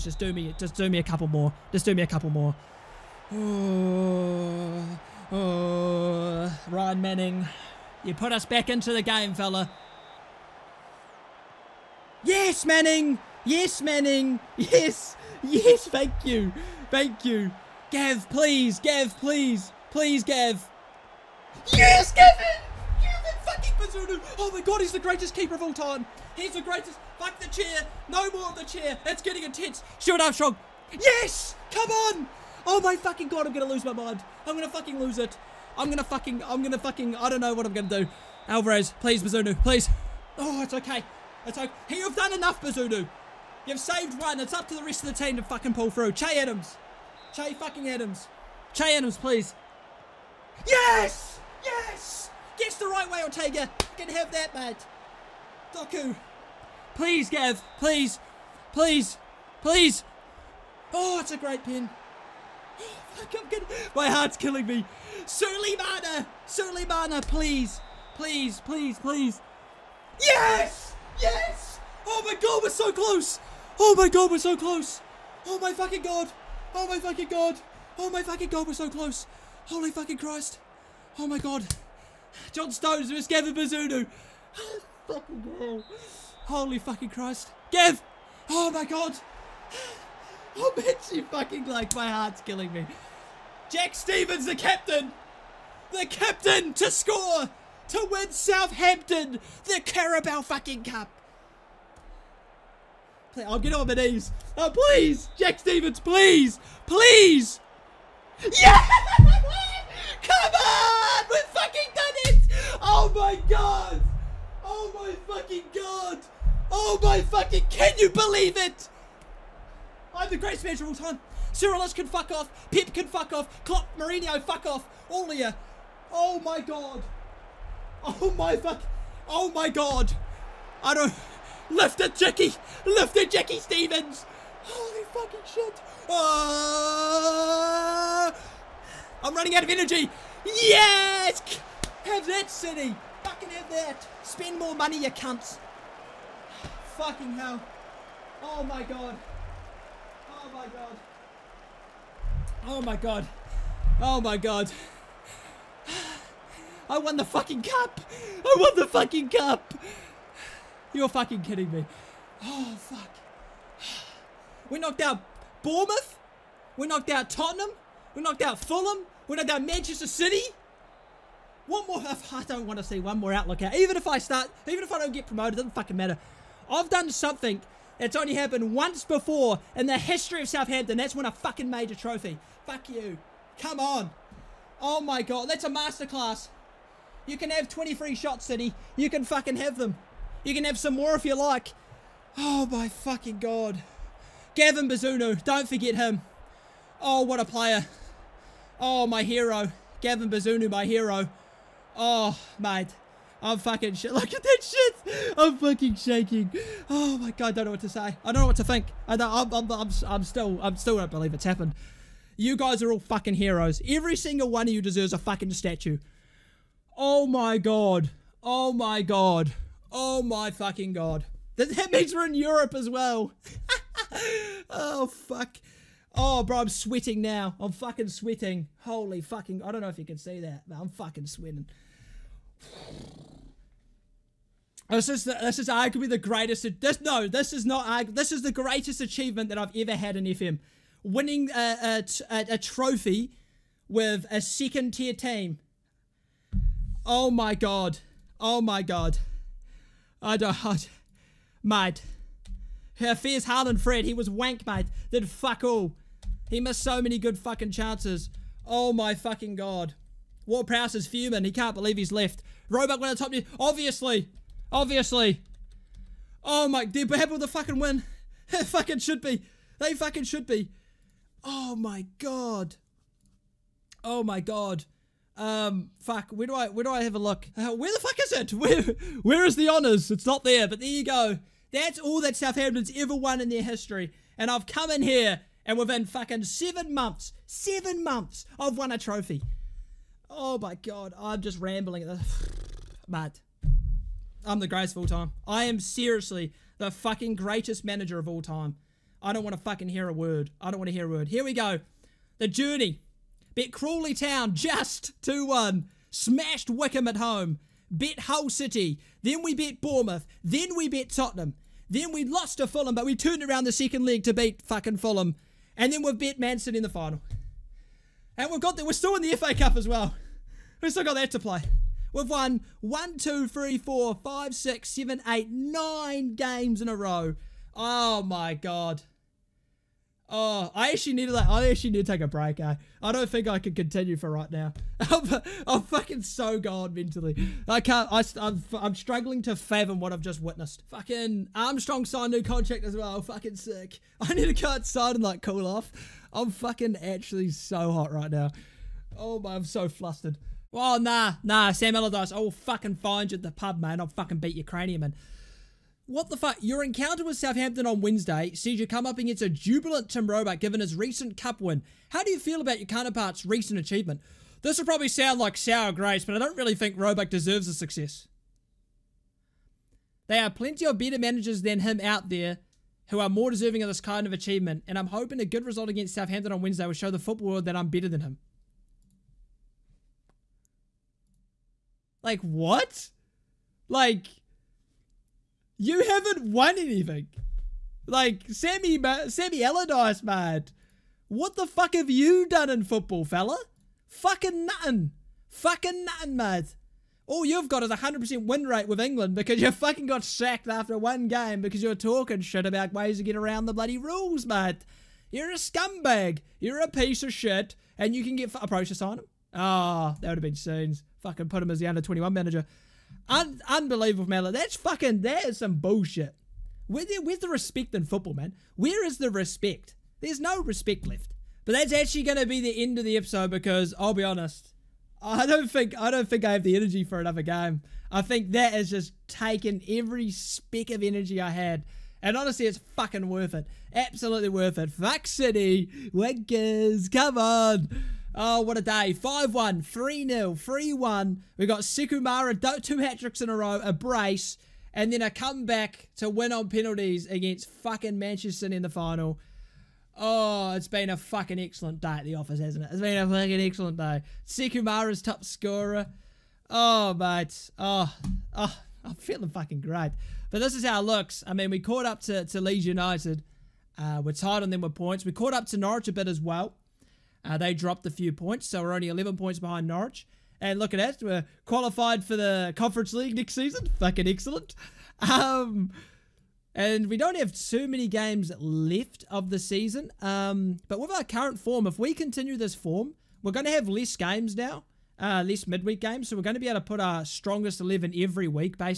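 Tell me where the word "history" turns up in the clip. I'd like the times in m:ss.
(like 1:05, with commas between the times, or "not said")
2:59, 4:43.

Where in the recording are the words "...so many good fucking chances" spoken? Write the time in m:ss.
4:16.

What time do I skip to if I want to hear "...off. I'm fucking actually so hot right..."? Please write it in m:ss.
5:45.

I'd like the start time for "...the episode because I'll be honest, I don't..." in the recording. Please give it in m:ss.
7:03.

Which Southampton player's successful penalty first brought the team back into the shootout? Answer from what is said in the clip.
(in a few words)
Ryan Manning.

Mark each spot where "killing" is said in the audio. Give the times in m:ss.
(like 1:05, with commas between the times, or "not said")
1:04, 1:32.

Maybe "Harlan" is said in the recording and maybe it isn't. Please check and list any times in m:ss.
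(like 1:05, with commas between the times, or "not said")
4:13.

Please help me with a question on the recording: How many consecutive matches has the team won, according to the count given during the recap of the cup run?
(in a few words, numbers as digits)
9.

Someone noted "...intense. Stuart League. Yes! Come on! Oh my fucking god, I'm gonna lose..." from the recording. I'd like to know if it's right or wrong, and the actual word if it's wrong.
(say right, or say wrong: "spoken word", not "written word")
wrong: "Armstrong", not "League".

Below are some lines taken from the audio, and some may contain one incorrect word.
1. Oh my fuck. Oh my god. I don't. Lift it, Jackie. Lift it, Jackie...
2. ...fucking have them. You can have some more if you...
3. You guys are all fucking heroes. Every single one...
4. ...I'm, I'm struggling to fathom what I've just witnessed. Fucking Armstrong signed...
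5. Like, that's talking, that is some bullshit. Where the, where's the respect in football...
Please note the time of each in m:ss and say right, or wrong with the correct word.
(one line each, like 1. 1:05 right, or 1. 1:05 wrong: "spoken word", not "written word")
1. 2:08 right
2. 3:09 right
3. 3:32 right
4. 5:38 right
5. 6:54 wrong: "fucking", not "talking".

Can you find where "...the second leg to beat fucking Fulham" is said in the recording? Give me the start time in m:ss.
5:13.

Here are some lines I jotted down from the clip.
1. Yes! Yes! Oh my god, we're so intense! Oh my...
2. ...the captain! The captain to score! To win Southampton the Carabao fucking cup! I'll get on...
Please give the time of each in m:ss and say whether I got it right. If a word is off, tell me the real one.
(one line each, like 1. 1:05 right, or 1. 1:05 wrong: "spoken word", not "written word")
1. 1:10 wrong: "close", not "intense"
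2. 1:34 right.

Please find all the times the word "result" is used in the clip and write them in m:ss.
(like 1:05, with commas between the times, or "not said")
6:15.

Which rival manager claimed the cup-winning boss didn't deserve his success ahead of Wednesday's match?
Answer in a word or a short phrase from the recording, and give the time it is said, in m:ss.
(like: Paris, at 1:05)
Sam Allardyce, at 5:51.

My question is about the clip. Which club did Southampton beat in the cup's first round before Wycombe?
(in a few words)
Crawley Town.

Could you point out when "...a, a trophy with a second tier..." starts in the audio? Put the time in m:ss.
4:02.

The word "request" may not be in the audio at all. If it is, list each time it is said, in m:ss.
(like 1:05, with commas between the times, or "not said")
not said.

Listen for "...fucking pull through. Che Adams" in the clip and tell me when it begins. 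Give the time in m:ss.
0:45.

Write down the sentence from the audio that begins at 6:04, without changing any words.
This will probably sound like sour grapes, but I don't really think Roebuck deserves the success.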